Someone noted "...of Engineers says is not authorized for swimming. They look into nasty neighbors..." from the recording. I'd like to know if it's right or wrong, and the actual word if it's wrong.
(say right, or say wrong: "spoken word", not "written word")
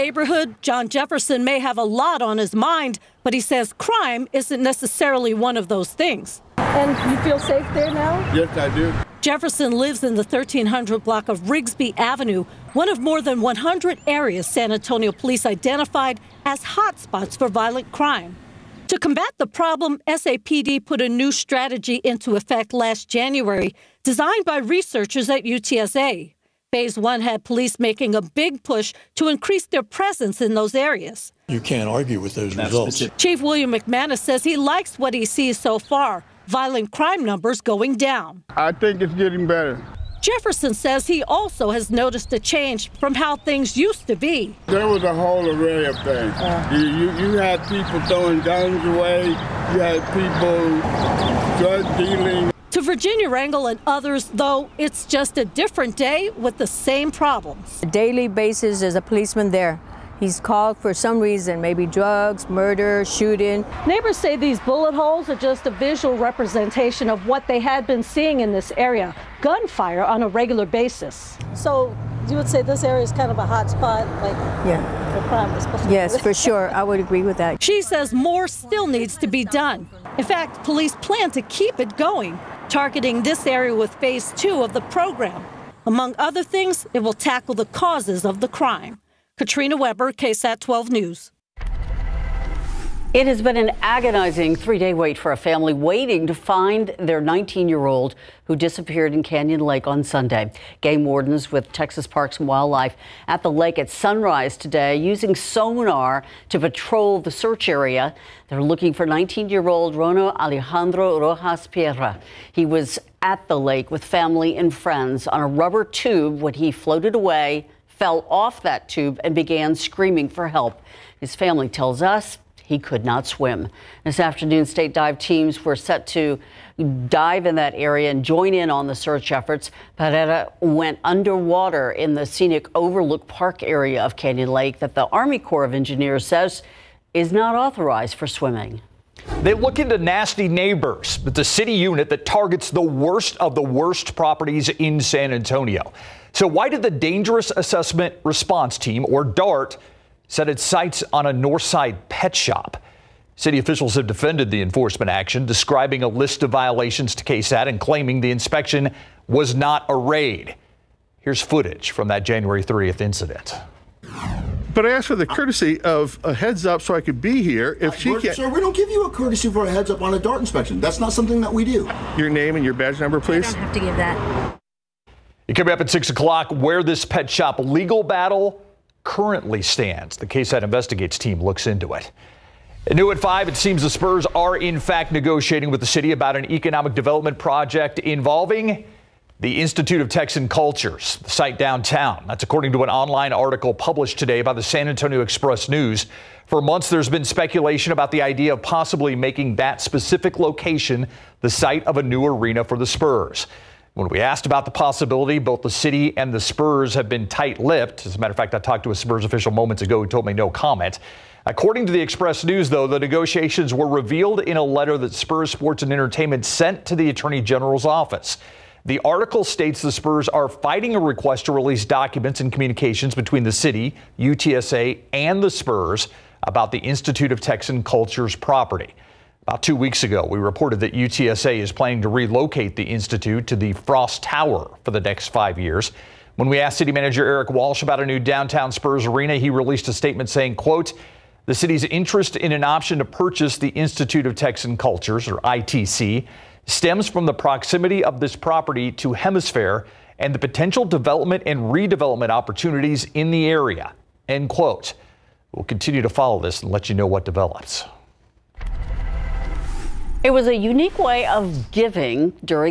right.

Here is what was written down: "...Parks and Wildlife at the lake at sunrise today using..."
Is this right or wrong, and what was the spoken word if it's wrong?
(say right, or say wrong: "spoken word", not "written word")
right.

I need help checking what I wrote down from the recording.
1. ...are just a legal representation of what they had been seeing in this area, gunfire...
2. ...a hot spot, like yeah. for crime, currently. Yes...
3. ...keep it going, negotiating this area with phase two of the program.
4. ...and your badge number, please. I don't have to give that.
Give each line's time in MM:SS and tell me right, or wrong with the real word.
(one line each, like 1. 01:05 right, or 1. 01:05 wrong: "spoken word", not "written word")
1. 01:05 wrong: "visual", not "legal"
2. 01:13 wrong: "especially", not "currently"
3. 01:21 wrong: "targeting", not "negotiating"
4. 02:52 right.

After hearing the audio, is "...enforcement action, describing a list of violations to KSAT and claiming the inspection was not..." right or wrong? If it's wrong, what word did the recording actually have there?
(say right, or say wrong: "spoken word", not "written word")
right.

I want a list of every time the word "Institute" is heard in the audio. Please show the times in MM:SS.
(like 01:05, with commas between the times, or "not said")
03:09, 03:46, 03:52, 04:03.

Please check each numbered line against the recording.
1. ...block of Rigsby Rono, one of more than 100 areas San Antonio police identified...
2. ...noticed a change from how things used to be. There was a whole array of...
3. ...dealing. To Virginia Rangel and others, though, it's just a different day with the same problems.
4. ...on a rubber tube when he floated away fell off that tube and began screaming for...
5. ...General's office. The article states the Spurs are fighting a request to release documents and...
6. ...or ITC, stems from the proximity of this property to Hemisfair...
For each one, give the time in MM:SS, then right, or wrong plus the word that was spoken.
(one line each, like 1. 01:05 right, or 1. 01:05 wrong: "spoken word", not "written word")
1. 00:11 wrong: "Avenue", not "Rono"
2. 00:41 right
3. 00:51 right
4. 01:55 right
5. 03:37 right
6. 04:05 right.